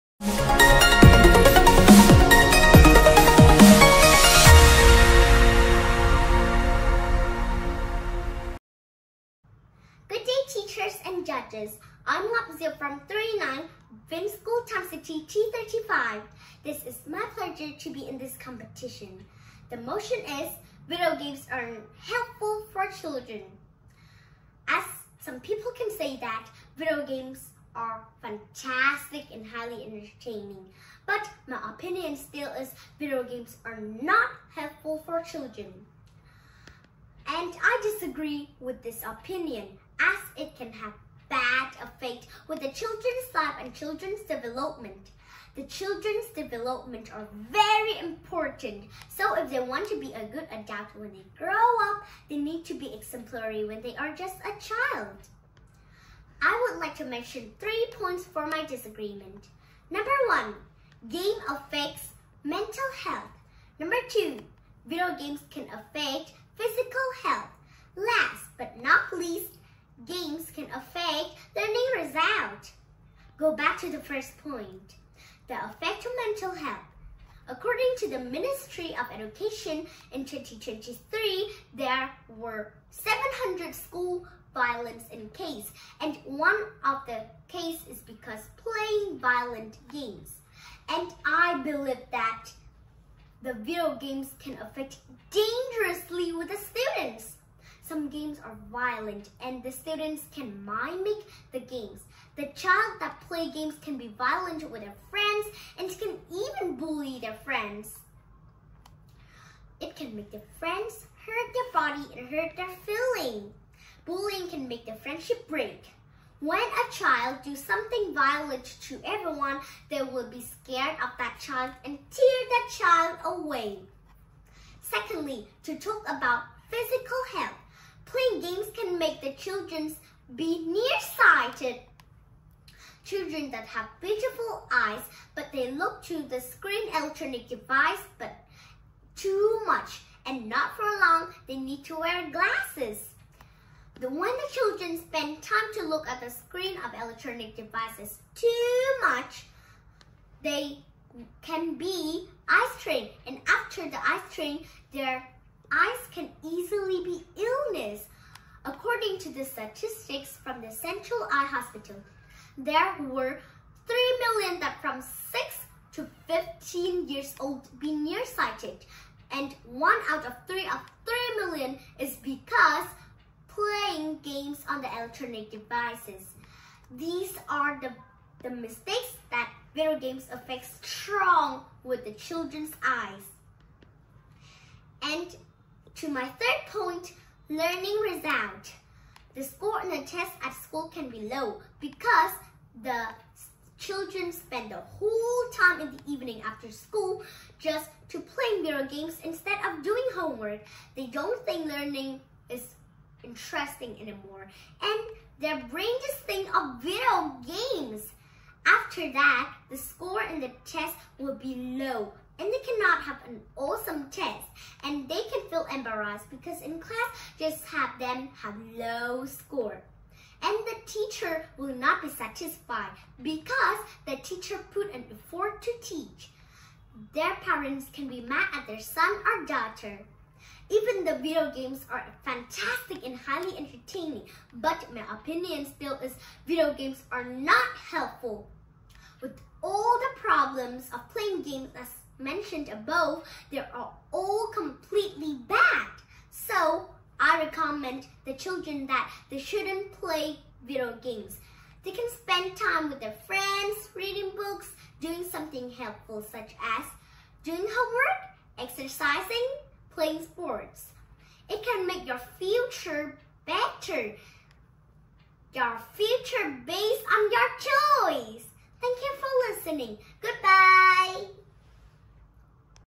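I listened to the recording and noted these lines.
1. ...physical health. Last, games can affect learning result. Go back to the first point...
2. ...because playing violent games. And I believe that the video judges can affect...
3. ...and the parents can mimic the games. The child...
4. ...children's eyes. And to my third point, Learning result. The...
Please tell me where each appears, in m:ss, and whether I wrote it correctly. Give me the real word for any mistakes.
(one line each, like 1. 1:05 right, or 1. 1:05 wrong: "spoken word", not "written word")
1. 1:06 right
2. 1:27 wrong: "games", not "judges"
3. 1:39 wrong: "students", not "parents"
4. 3:02 right.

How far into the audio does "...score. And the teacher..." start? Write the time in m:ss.
3:39.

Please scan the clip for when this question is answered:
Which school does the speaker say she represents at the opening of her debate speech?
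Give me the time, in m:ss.
0:14.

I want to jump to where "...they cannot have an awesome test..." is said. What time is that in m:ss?
3:32.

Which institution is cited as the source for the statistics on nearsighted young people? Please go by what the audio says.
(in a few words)
Central Eye Hospital.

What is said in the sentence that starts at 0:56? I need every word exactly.
I would like to mention three points for my disagreement.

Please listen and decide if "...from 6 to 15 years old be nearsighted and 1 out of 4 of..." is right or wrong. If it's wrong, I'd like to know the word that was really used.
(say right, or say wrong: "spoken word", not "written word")
wrong: "3", not "4".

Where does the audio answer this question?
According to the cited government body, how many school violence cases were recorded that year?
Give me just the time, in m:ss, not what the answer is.
1:22.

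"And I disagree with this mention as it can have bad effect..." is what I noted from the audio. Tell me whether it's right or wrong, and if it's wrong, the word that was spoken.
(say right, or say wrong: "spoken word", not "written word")
wrong: "opinion", not "mention".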